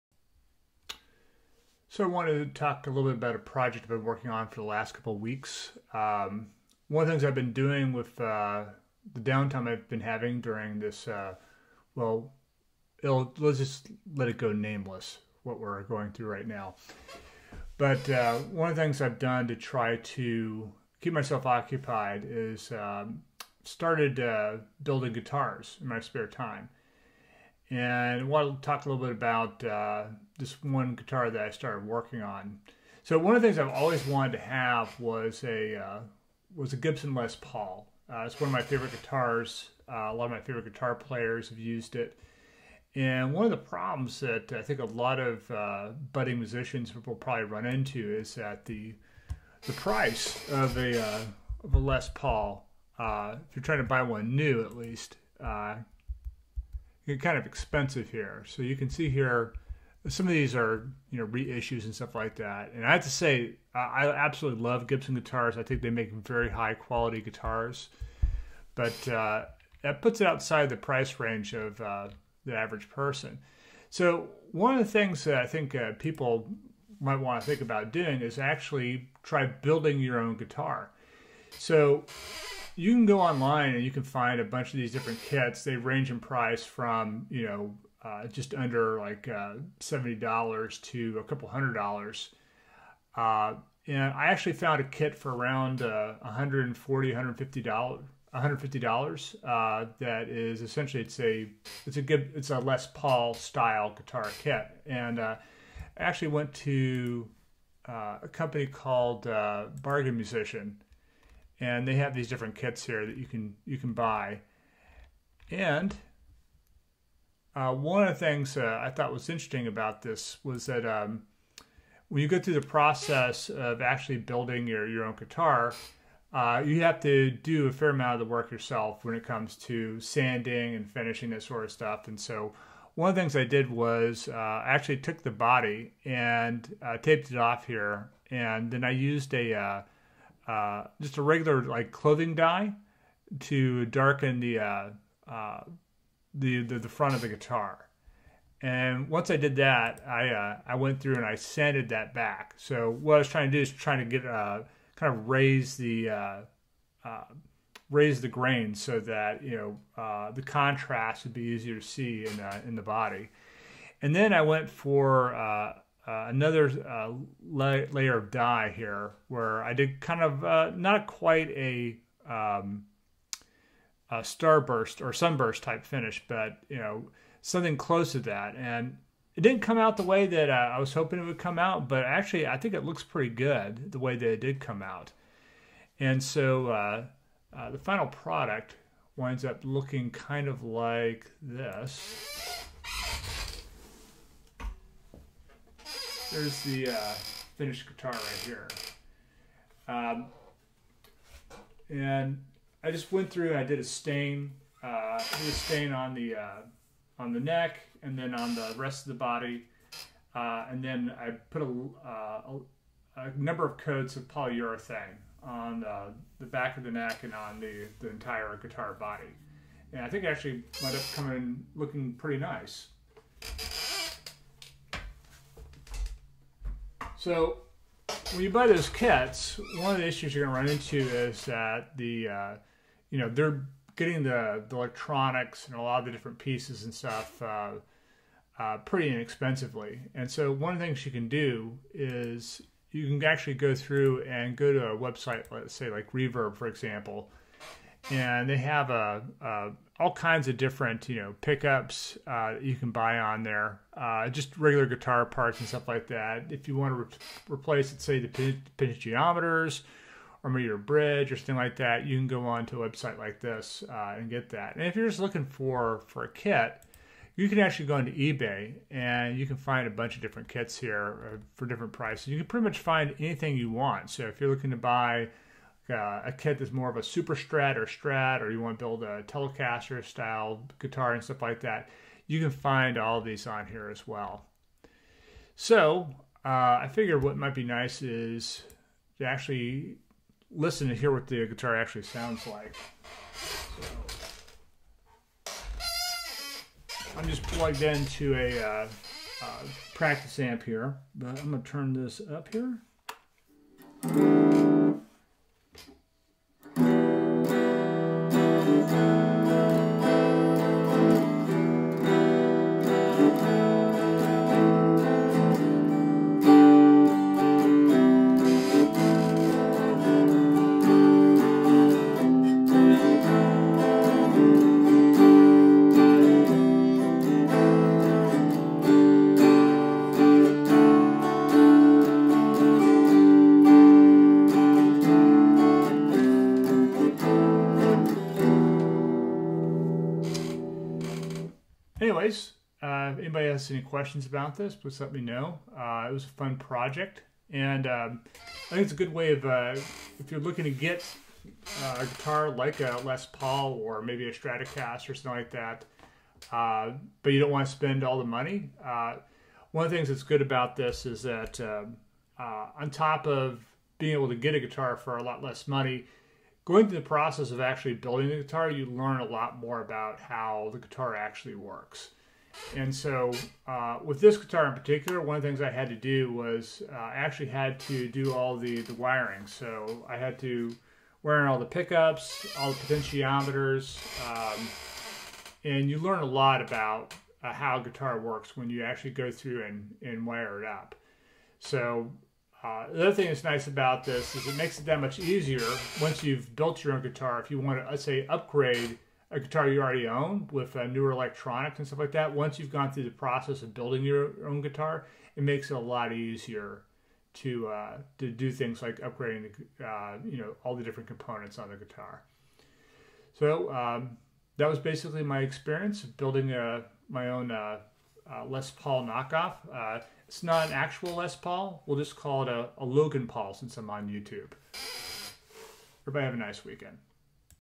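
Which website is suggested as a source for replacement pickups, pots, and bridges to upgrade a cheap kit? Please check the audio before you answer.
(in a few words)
Reverb.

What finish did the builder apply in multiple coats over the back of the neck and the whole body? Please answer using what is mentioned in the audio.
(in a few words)
polyurethane.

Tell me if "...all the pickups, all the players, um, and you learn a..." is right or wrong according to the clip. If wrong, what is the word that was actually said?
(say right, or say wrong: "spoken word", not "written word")
wrong: "potentiometers", not "players".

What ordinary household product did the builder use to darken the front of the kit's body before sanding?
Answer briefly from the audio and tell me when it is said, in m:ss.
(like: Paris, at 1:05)
clothing dye, at 2:21.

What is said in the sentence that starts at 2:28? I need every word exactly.
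And once I did that, I uh, I went through and I sanded that back.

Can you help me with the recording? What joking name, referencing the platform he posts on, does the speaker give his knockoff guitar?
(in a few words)
Logan Paul.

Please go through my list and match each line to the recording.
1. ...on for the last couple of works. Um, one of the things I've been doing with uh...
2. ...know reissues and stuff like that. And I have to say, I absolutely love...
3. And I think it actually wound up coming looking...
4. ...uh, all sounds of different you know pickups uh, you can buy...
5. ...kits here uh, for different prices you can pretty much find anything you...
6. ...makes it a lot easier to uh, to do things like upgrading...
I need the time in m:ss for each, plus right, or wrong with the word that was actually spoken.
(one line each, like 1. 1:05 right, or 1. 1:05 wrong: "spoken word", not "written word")
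1. 0:04 wrong: "weeks", not "works"
2. 1:01 right
3. 3:39 right
4. 4:09 wrong: "kinds", not "sounds"
5. 4:30 right
6. 6:45 right.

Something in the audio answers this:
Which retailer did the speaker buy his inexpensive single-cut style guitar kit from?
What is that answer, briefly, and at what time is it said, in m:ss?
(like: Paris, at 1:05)
Bargain Musician, at 1:49.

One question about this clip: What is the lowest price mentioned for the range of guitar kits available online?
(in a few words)
$70.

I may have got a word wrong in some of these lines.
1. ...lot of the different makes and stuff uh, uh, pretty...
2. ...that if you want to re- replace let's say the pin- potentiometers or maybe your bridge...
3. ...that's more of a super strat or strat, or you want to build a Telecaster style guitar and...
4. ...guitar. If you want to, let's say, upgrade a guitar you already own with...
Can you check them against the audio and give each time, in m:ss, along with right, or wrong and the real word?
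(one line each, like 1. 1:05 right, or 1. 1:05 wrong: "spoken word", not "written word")
1. 3:55 wrong: "pieces", not "makes"
2. 4:16 right
3. 4:36 right
4. 6:37 right.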